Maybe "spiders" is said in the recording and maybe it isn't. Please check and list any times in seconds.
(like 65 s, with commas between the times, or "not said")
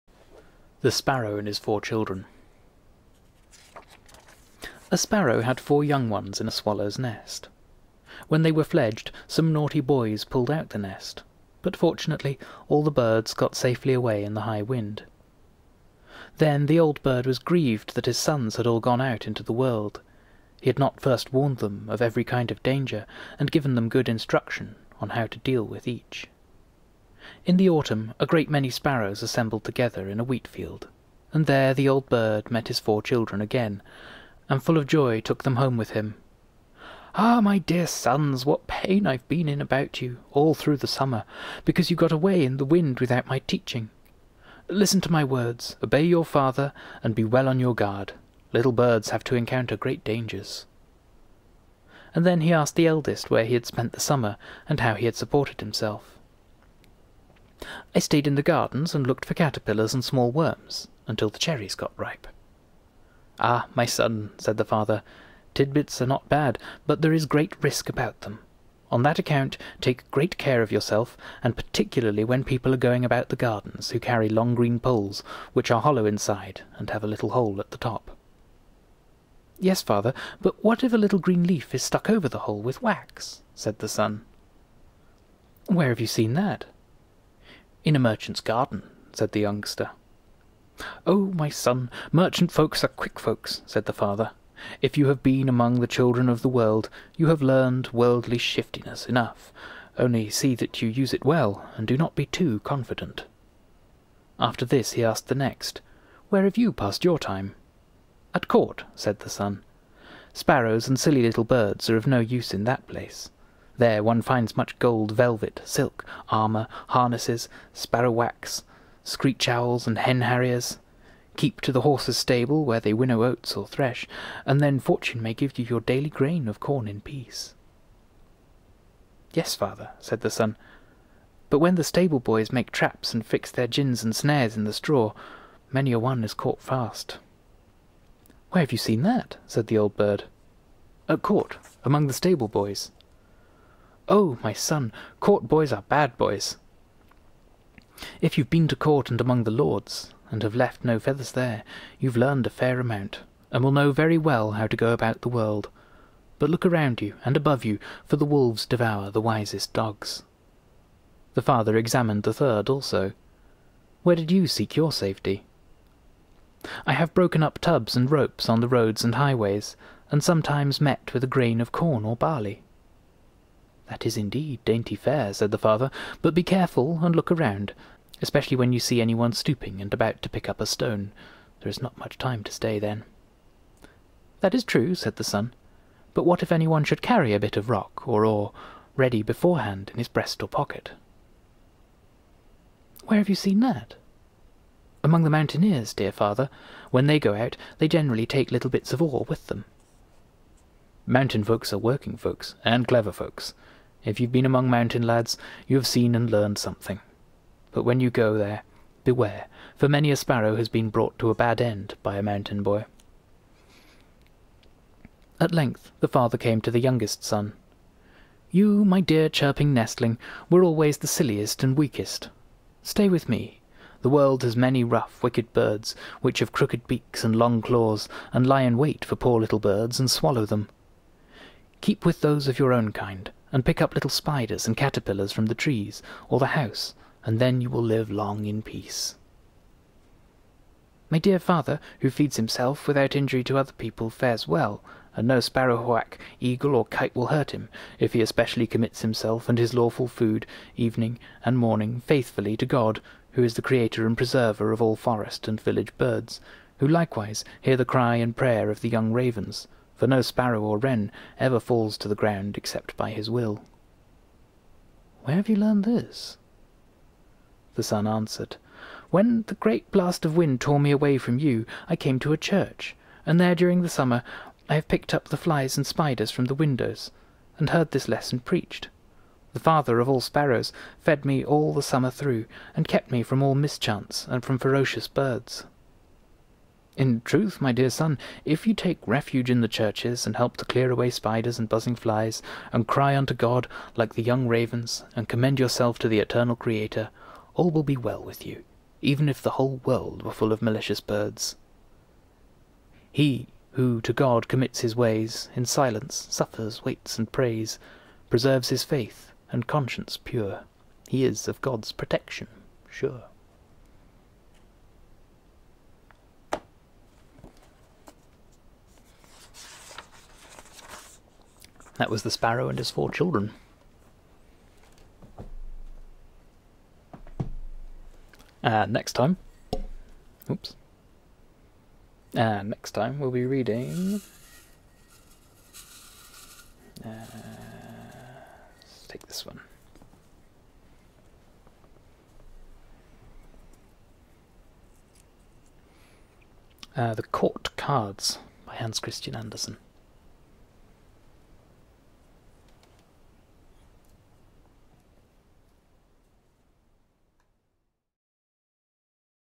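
234 s, 275 s, 291 s.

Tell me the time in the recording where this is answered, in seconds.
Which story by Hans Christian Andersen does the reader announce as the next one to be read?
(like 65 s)
347 s.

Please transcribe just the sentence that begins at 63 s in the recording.
Ah, my son, said the father, tidbits are not bad, but there is great risk about them.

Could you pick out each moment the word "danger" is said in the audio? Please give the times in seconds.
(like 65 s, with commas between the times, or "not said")
22 s, 50 s.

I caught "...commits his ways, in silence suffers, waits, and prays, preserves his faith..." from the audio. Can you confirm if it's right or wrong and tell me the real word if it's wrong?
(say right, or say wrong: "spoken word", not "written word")
right.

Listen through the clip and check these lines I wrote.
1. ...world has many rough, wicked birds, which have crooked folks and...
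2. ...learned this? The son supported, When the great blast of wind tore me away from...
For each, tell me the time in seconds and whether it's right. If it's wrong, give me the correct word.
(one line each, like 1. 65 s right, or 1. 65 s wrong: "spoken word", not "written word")
1. 224 s wrong: "beaks", not "folks"
2. 265 s wrong: "answered", not "supported".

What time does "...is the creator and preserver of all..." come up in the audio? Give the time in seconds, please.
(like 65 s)
253 s.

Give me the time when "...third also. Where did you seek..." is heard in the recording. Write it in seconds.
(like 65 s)
162 s.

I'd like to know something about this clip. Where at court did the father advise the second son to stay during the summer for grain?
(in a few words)
the horses' stable.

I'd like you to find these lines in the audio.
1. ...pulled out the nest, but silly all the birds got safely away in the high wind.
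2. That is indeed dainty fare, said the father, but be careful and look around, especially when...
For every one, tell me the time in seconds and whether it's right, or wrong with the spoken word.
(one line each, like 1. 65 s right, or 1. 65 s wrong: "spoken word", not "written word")
1. 10 s wrong: "fortunately", not "silly"
2. 173 s right.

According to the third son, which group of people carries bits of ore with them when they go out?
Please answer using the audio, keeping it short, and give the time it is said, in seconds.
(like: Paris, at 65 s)
the mountaineers, at 195 s.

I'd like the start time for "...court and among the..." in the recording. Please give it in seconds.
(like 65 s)
148 s.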